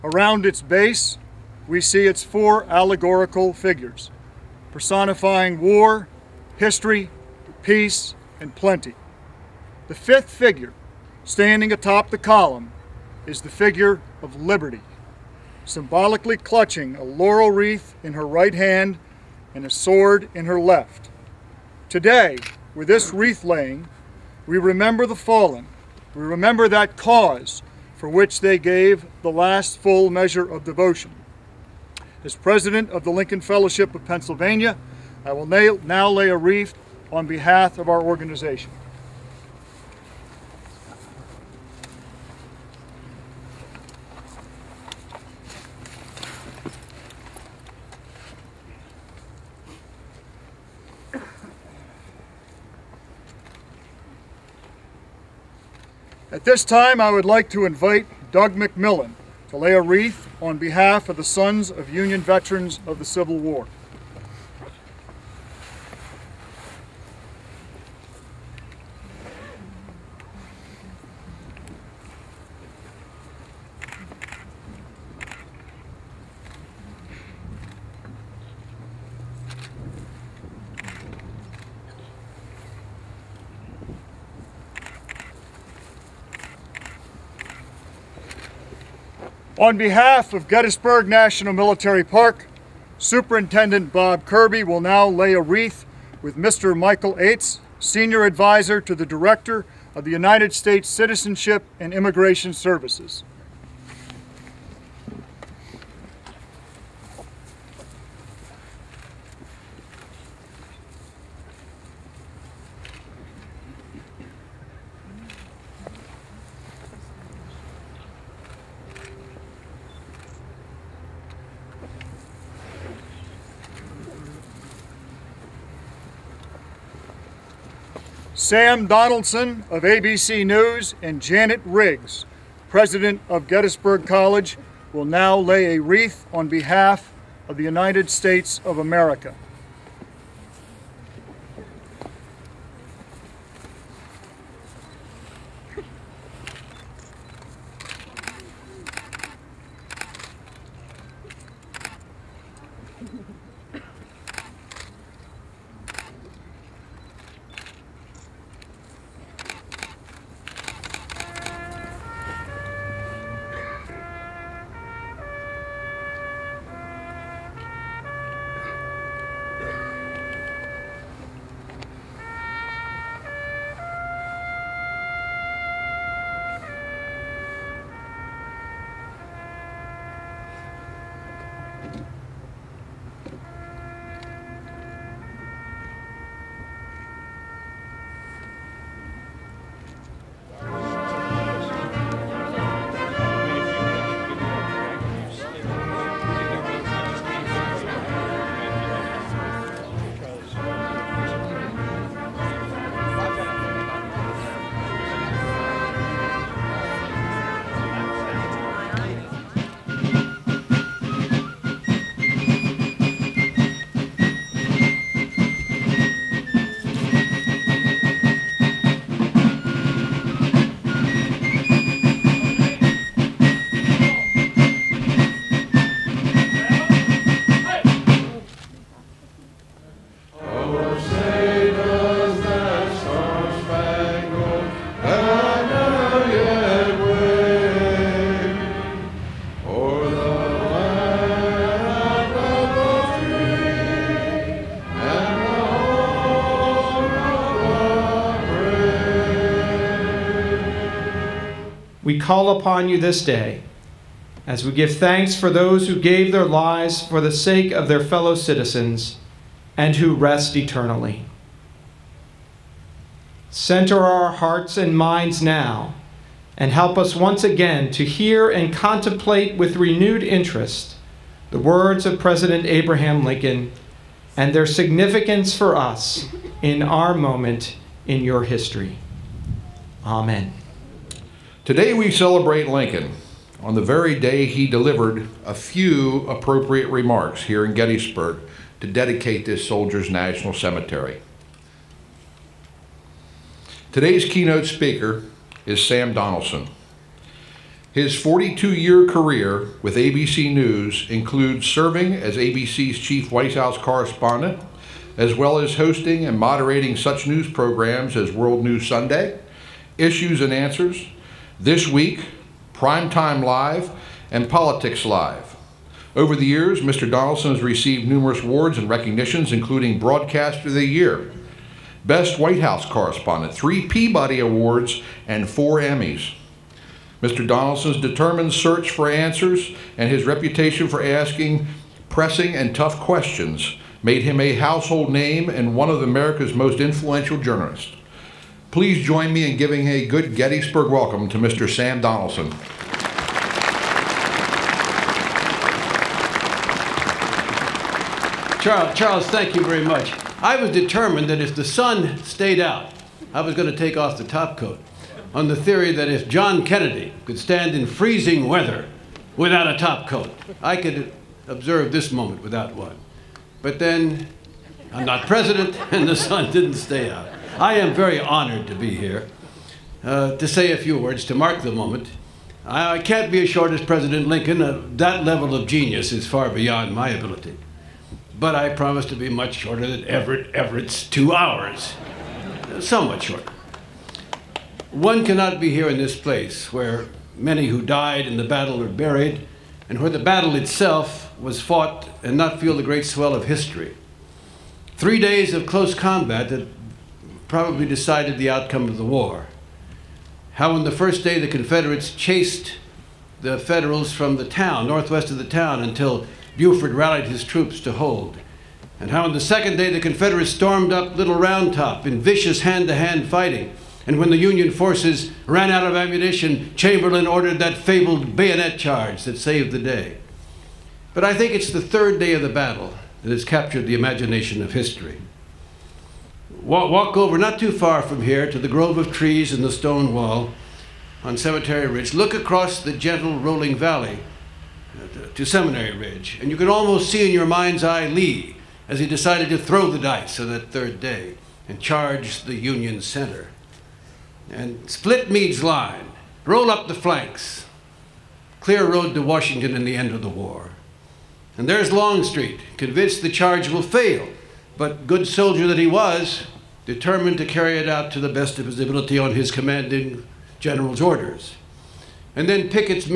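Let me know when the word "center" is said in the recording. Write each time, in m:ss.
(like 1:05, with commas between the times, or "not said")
4:23, 7:23.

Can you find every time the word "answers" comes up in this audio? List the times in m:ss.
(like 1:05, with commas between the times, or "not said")
5:10, 5:29.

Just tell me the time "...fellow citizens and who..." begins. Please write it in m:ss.
4:18.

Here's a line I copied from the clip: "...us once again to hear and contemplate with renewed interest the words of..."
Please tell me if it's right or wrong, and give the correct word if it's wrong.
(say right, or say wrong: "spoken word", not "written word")
right.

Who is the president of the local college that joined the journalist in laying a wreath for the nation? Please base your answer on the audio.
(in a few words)
Janet Riggs.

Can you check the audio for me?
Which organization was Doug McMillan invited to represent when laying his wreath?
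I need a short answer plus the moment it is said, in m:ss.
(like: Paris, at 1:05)
Sons of Union Veterans of the Civil War, at 1:01.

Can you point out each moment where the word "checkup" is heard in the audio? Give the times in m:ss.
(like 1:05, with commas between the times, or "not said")
not said.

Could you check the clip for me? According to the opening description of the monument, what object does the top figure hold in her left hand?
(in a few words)
A sword.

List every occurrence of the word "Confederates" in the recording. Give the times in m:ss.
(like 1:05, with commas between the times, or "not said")
6:41, 6:49.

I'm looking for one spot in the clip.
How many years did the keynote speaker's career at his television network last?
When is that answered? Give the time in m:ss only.
4:58.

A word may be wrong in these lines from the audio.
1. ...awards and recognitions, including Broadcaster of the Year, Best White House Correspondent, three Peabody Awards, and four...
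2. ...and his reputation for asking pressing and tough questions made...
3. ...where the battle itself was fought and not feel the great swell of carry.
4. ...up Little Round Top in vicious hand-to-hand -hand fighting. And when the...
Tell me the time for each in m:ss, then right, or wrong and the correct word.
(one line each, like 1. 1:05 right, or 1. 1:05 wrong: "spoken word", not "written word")
1. 5:18 right
2. 5:29 right
3. 6:30 wrong: "history", not "carry"
4. 6:50 right.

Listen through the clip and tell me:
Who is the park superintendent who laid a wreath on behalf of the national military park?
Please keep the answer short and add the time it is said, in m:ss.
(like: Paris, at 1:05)
Bob Kirby, at 1:33.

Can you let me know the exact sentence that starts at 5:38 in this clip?
Please join me in giving a good Gettysburg welcome to Mr.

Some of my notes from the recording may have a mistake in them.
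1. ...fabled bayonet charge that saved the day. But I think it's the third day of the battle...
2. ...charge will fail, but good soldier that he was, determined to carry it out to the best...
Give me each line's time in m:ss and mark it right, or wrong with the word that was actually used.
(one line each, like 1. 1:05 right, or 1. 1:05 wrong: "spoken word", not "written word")
1. 6:57 right
2. 7:33 right.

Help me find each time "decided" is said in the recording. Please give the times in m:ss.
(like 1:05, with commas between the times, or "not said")
6:37, 7:19.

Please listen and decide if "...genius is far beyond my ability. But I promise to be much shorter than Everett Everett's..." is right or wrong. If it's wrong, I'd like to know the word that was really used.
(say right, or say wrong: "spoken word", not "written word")
right.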